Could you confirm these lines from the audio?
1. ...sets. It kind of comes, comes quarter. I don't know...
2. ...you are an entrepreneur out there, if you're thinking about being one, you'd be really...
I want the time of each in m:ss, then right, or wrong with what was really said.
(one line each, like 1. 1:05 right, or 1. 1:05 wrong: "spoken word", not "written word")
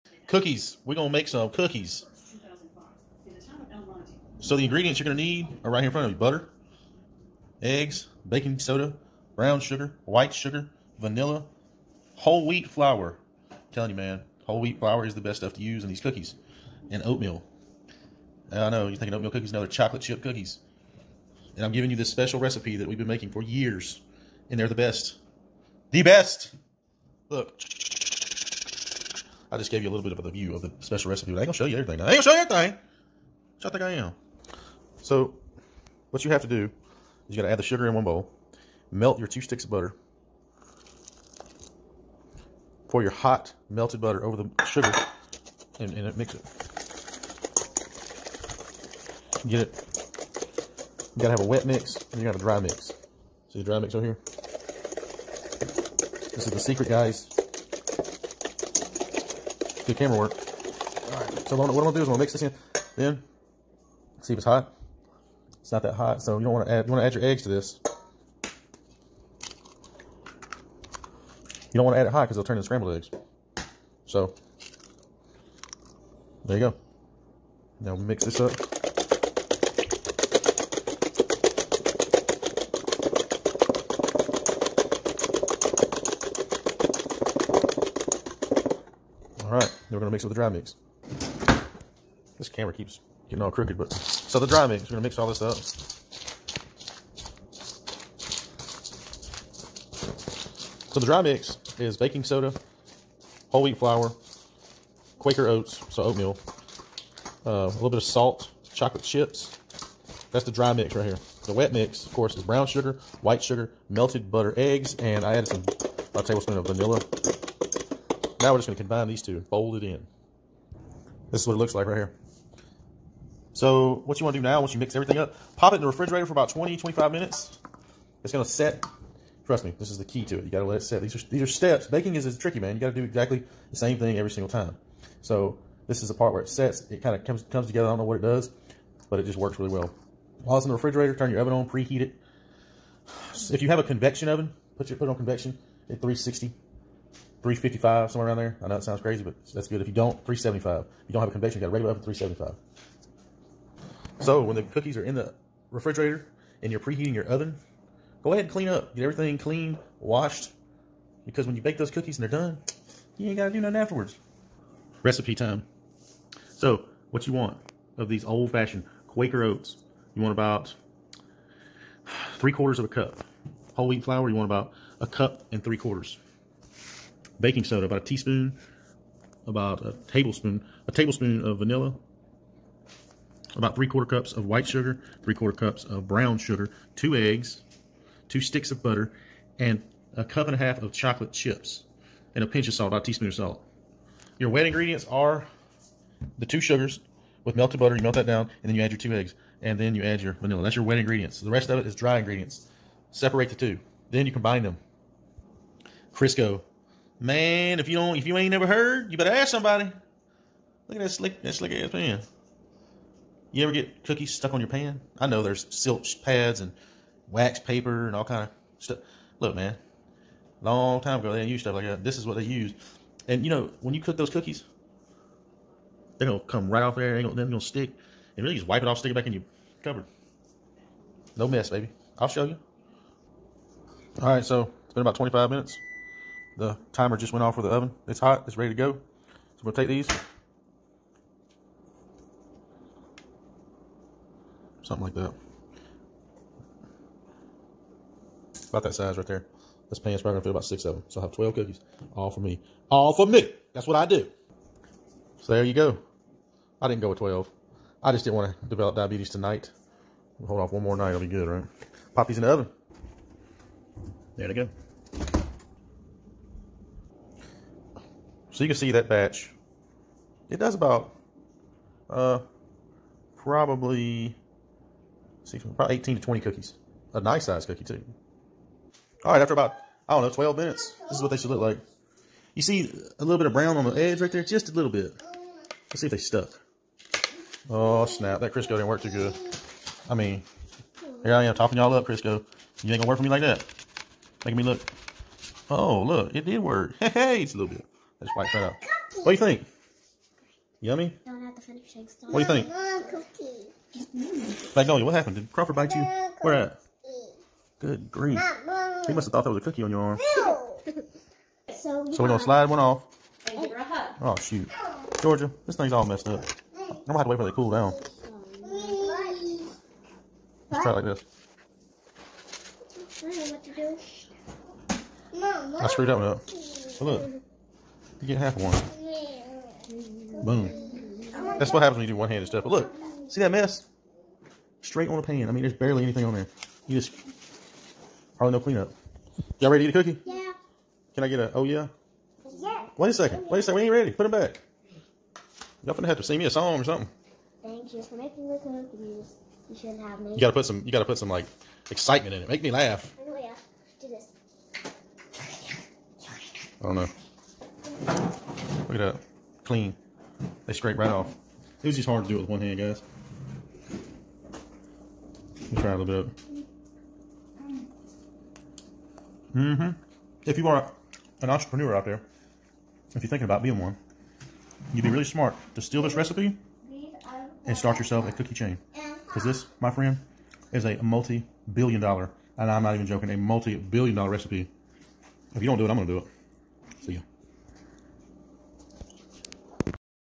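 1. 2:16 wrong: "together", not "quarter"
2. 6:10 right.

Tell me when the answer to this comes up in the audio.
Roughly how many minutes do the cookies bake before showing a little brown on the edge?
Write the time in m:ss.
4:39.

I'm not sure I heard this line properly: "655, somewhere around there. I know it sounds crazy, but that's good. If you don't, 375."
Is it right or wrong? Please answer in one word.
wrong.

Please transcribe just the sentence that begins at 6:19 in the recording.
Because this, my friend, is a multi-billion dollar, and I'm not even joking, a multi-billion dollar recipe.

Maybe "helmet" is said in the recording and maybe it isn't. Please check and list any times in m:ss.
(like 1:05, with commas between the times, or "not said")
not said.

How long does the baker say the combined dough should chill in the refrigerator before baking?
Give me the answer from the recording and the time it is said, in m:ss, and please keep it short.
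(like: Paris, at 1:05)
20 to 25 minutes, at 2:06.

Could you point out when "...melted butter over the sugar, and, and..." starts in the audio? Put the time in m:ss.
0:43.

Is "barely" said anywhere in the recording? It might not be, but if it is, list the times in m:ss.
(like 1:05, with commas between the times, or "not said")
5:35.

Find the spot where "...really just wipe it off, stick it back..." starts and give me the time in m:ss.
3:48.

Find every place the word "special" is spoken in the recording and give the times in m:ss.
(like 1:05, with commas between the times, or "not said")
0:22, 0:30.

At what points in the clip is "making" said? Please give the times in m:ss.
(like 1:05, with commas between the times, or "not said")
0:23, 4:54, 5:48.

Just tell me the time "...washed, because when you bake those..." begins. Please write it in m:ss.
2:39.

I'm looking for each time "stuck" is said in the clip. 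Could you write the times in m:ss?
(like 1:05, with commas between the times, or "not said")
3:34, 4:46.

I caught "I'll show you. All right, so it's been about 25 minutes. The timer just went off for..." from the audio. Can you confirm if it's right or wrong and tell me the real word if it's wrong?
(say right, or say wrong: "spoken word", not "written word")
right.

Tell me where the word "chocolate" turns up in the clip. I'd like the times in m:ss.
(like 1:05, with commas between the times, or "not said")
0:19, 1:48, 3:10.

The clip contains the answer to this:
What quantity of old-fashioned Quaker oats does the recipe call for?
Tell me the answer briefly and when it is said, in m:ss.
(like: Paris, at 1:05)
3/4 cup, at 2:50.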